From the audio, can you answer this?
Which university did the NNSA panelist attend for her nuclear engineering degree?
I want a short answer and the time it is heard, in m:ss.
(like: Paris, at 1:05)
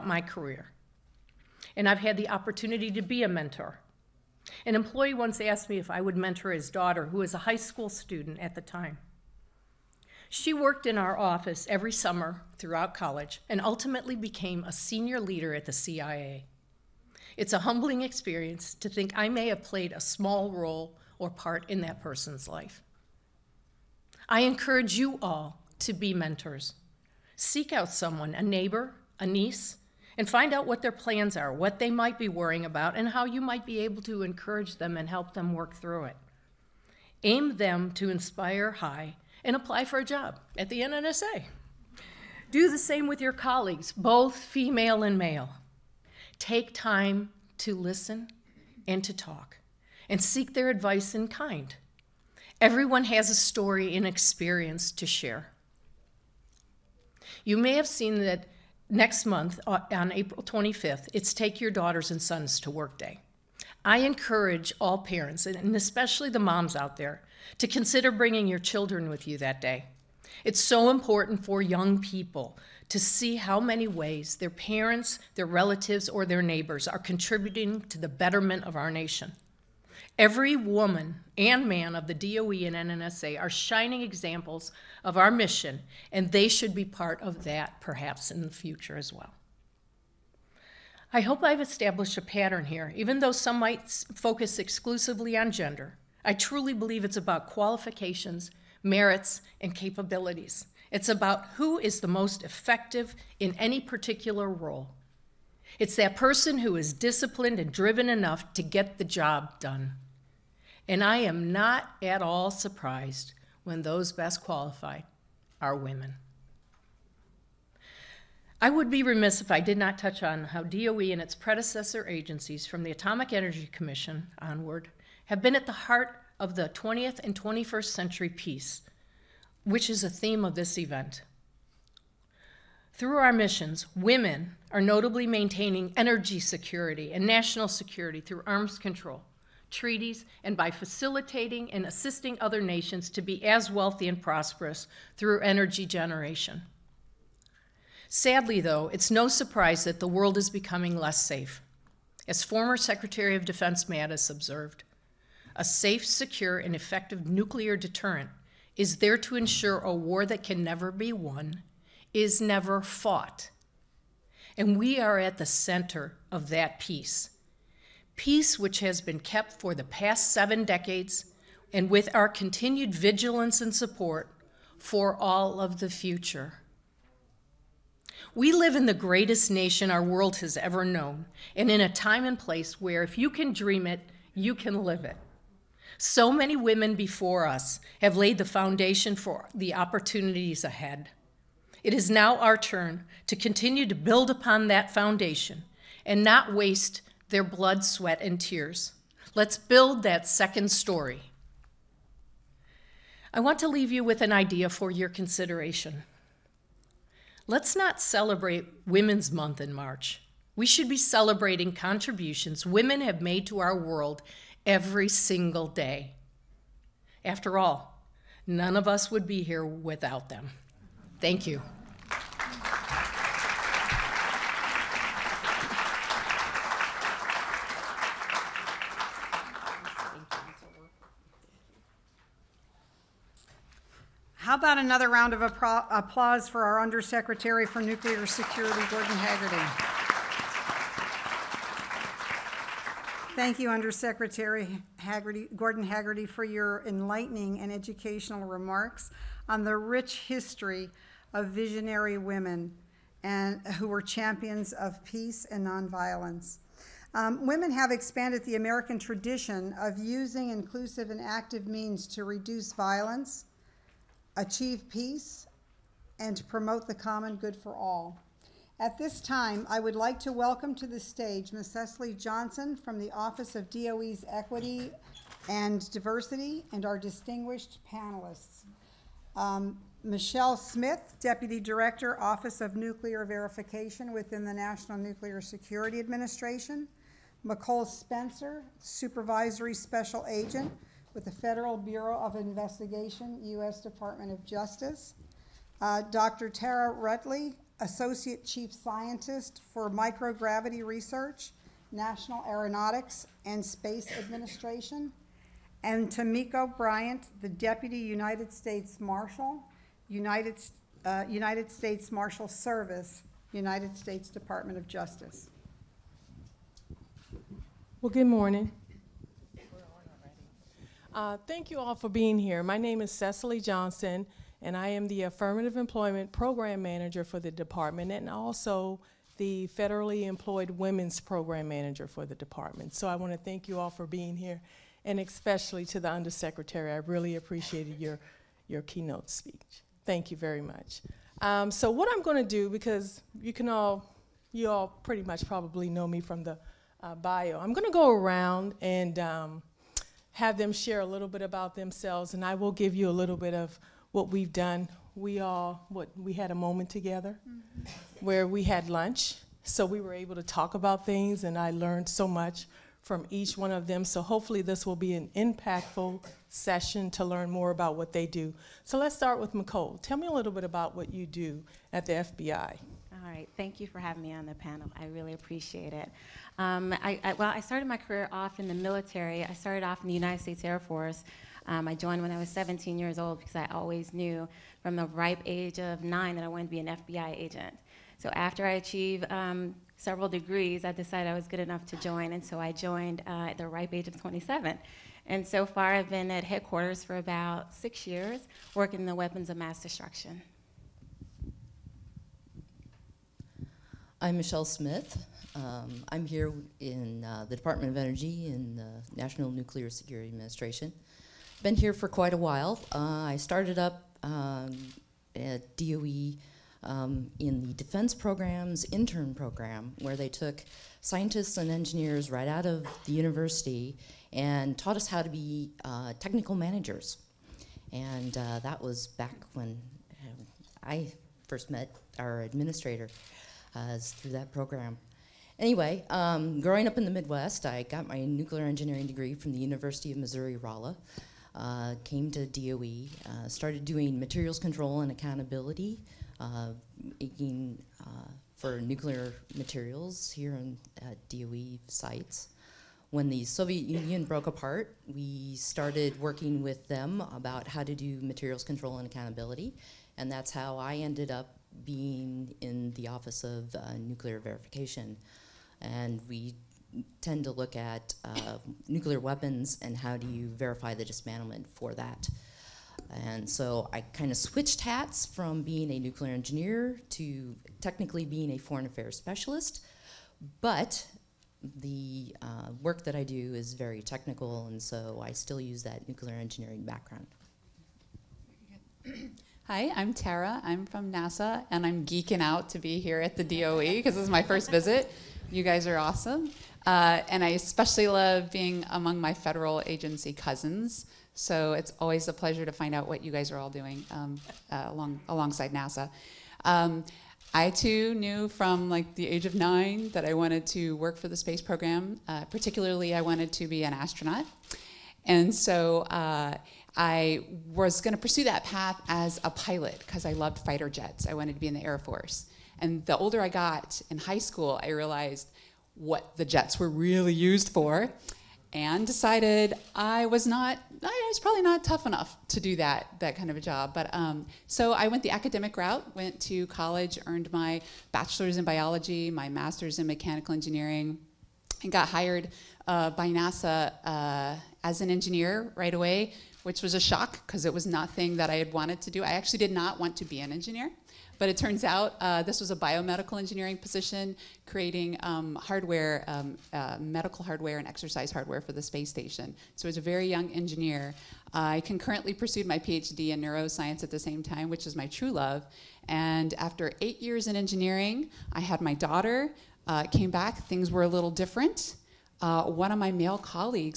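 University of Missouri-Rolla, at 7:19.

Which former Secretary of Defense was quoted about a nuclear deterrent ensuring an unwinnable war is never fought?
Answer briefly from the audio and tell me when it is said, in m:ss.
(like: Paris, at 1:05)
Mattis, at 2:33.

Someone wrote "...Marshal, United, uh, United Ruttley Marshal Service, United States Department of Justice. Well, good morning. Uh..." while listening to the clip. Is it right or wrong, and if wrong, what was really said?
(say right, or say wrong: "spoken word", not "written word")
wrong: "States", not "Ruttley".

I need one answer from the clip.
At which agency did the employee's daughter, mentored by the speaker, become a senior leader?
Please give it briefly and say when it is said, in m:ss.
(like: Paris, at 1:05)
CIA, at 0:15.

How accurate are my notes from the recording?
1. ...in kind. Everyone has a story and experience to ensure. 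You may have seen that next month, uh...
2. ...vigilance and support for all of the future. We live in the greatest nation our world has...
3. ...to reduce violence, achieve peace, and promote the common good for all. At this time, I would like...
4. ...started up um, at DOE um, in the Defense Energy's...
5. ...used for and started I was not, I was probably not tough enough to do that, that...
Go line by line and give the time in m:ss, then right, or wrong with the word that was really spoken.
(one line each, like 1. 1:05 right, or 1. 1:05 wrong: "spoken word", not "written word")
1. 0:51 wrong: "share", not "ensure"
2. 2:52 right
3. 4:22 right
4. 6:53 wrong: "Program", not "Energy"
5. 8:47 wrong: "decided", not "started".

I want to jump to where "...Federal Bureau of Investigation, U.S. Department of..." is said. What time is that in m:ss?
4:51.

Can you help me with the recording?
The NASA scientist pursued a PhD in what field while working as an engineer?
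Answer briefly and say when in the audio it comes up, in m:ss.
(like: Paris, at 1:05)
neuroscience, at 9:23.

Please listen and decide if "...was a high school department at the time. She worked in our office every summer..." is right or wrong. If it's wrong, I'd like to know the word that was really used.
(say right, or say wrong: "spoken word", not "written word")
wrong: "student", not "department".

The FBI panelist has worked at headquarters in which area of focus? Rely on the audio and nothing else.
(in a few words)
weapons of mass destruction.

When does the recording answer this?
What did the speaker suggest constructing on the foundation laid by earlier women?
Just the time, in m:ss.
3:20.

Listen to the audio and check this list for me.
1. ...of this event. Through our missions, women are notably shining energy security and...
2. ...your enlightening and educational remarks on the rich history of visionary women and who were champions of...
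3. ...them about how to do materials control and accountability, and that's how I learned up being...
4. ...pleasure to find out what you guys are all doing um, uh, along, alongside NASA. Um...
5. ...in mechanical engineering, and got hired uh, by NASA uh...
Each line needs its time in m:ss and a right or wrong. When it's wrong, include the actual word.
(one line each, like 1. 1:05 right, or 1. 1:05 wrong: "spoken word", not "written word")
1. 2:10 wrong: "maintaining", not "shining"
2. 4:06 right
3. 7:36 wrong: "ended", not "learned"
4. 8:22 right
5. 8:59 right.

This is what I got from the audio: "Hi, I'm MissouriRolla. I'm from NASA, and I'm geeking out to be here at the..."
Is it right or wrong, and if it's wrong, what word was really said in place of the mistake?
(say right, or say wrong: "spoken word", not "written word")
wrong: "Tara", not "MissouriRolla".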